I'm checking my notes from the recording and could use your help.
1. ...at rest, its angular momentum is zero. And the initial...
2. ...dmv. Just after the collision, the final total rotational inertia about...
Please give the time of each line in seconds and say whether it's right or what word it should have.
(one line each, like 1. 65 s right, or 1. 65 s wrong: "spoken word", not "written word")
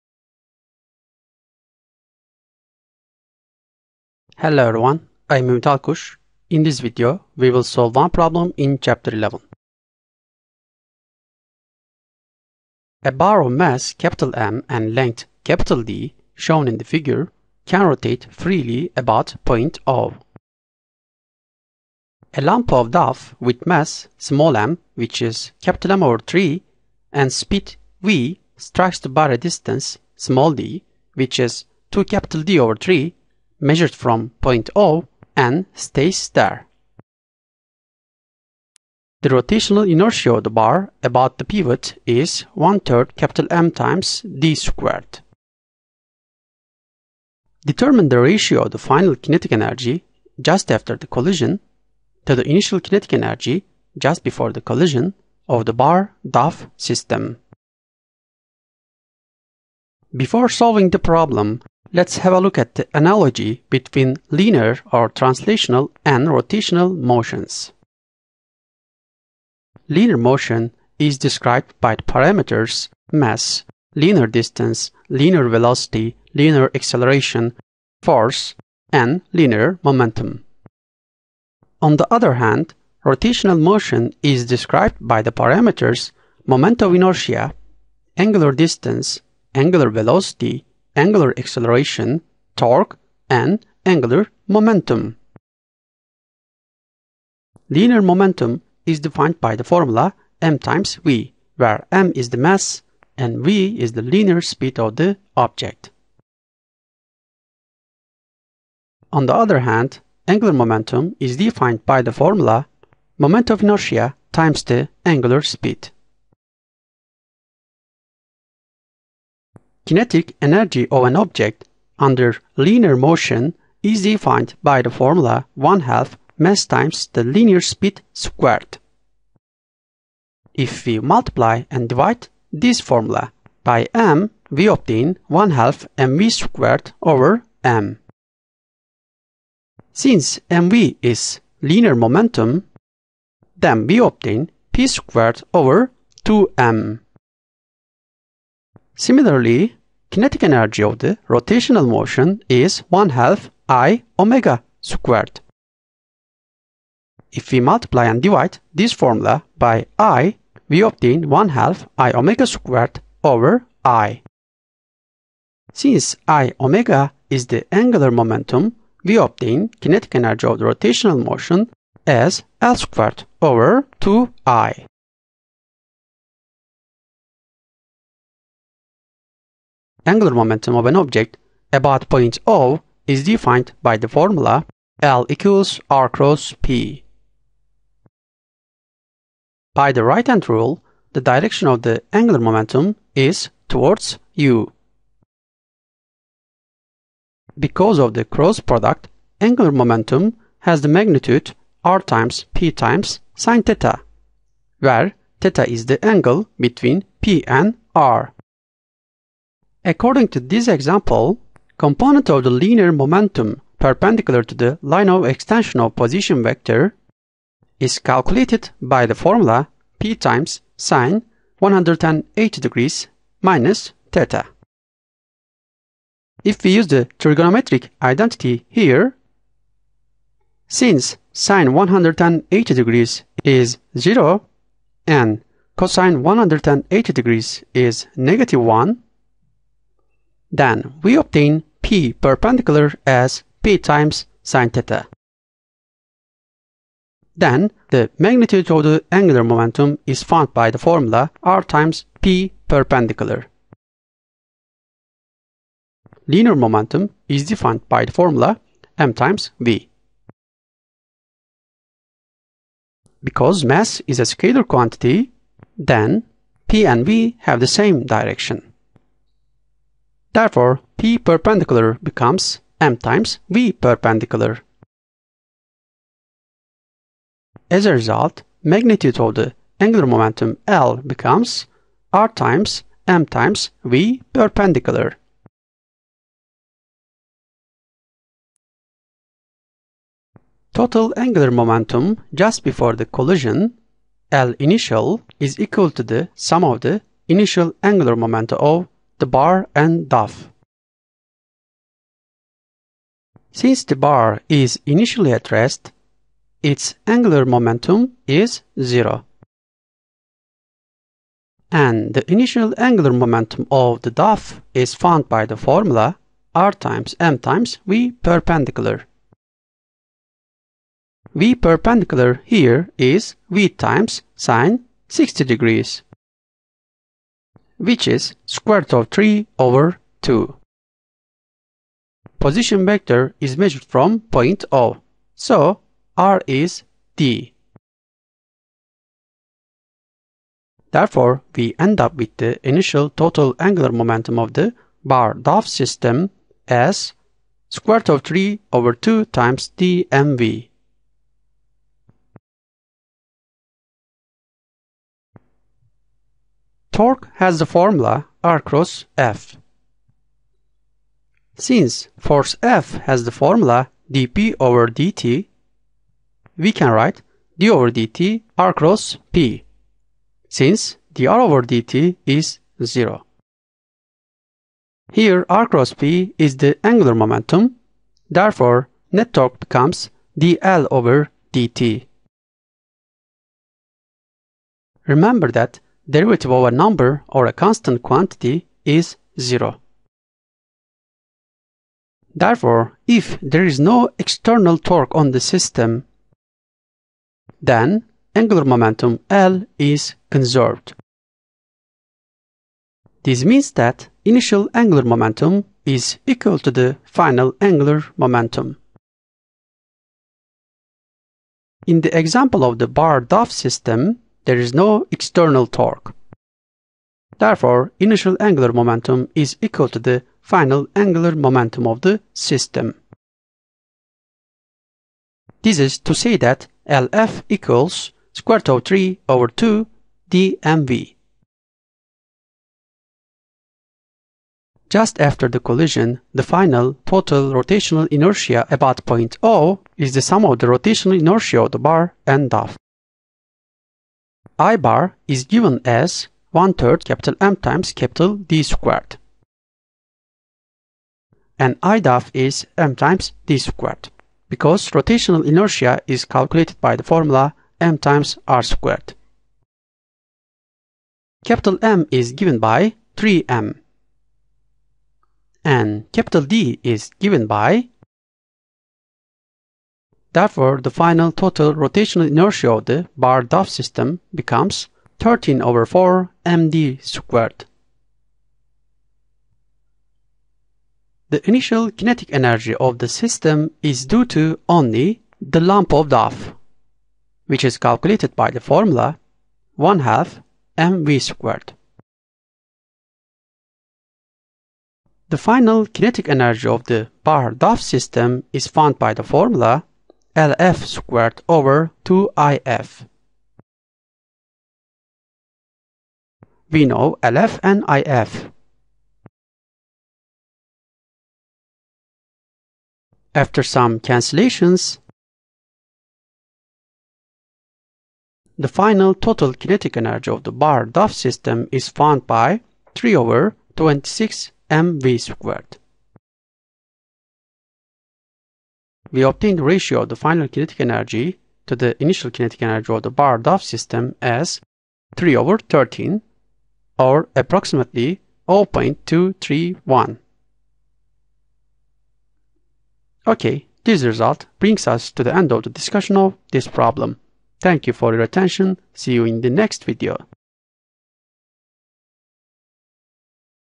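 1. 305 s right
2. 430 s right.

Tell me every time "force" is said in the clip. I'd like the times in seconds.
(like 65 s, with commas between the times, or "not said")
78 s, 362 s.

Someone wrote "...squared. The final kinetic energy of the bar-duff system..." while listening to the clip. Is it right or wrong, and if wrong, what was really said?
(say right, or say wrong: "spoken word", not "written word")
right.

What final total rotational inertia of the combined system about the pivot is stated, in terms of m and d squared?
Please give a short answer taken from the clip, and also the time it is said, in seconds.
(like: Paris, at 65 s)
13/4 md², at 475 s.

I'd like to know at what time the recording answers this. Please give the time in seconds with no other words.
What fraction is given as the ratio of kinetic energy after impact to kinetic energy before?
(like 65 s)
535 s.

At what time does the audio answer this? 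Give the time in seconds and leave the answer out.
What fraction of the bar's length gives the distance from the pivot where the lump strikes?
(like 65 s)
31 s.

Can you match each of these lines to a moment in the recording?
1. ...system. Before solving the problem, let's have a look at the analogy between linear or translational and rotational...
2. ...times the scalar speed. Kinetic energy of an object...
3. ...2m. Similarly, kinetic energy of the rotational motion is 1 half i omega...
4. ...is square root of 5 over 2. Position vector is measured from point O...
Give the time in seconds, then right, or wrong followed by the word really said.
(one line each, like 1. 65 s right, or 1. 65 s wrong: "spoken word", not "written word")
1. 56 s right
2. 114 s wrong: "angular", not "scalar"
3. 146 s right
4. 328 s wrong: "3", not "5".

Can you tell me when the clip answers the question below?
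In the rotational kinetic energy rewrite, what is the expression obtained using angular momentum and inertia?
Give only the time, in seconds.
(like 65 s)
172 s.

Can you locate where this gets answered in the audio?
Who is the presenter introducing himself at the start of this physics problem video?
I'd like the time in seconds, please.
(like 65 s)
5 s.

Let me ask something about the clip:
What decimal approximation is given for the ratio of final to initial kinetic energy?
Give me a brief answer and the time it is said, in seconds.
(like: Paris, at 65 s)
0.231, at 538 s.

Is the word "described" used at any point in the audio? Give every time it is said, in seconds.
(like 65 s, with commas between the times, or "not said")
71 s, 84 s.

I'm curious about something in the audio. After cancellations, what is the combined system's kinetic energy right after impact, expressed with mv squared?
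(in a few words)
3/26 mv².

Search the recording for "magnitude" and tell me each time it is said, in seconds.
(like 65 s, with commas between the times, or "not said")
200 s, 248 s, 278 s.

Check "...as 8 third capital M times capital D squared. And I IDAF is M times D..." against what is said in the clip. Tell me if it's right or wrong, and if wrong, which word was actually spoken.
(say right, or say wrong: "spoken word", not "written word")
wrong: "1", not "8".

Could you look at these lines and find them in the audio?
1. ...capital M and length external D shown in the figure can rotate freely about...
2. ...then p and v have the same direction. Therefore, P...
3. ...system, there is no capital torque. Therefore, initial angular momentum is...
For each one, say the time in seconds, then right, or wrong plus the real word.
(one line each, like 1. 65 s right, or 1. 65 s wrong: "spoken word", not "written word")
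1. 13 s wrong: "capital", not "external"
2. 265 s right
3. 413 s wrong: "external", not "capital".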